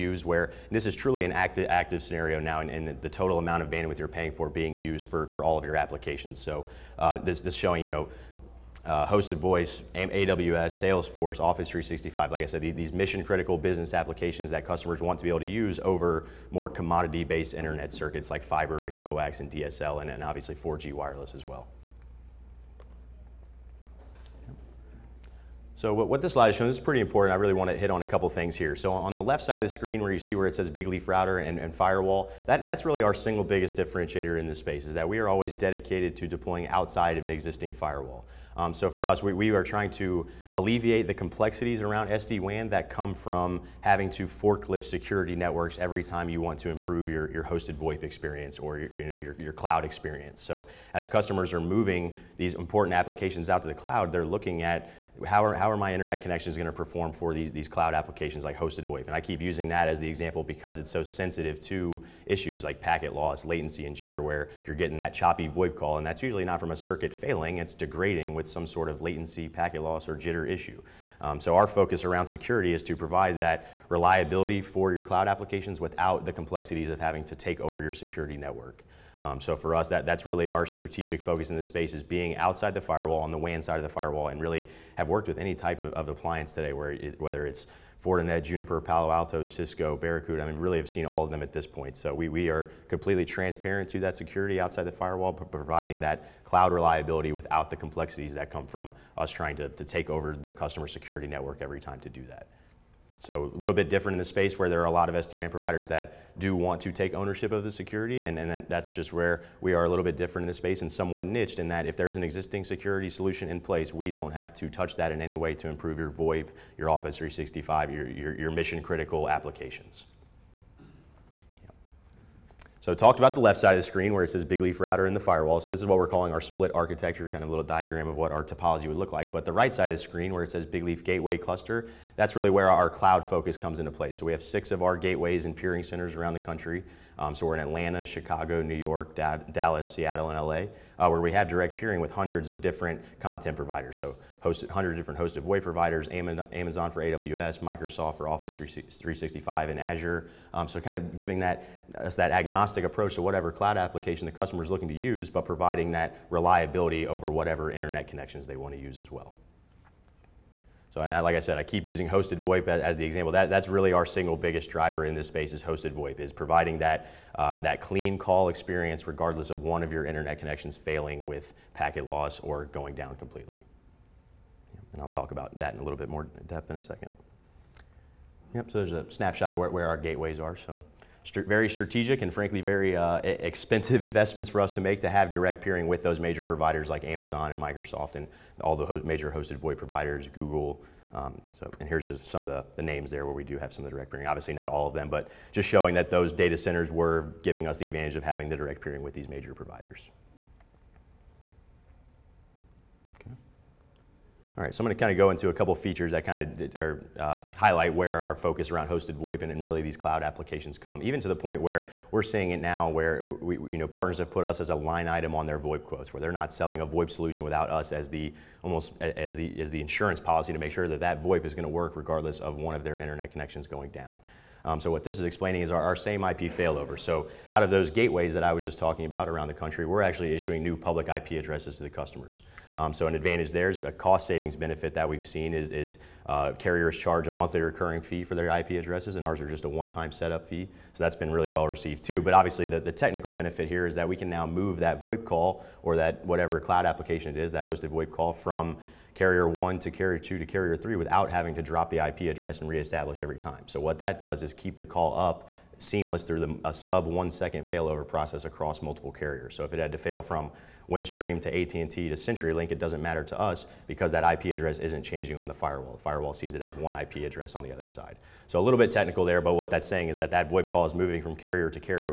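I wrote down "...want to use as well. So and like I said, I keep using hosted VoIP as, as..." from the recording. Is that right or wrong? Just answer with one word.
right.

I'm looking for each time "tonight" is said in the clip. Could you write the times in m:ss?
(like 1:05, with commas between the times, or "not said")
not said.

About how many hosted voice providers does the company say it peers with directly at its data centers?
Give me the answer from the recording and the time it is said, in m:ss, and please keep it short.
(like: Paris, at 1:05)
100, at 2:24.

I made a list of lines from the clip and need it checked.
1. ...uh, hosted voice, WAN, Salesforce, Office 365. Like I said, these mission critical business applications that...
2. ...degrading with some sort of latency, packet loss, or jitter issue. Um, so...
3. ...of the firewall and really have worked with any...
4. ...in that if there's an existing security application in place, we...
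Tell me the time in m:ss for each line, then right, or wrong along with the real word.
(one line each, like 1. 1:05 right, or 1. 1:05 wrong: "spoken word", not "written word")
1. 0:08 wrong: "AWS", not "WAN"
2. 1:07 right
3. 1:23 right
4. 1:51 wrong: "solution", not "application".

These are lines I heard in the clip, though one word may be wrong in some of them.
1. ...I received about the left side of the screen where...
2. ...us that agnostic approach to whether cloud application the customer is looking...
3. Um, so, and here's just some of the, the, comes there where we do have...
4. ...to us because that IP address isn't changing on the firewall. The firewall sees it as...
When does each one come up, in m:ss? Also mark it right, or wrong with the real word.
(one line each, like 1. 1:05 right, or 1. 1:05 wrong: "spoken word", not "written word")
1. 2:02 wrong: "talked", not "received"
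2. 2:31 wrong: "whatever", not "whether"
3. 3:11 wrong: "names", not "comes"
4. 4:23 right.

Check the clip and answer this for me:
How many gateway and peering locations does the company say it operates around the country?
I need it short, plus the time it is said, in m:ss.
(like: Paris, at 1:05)
6, at 2:14.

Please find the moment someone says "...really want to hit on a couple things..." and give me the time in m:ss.
0:27.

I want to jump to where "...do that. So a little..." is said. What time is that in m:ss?
1:42.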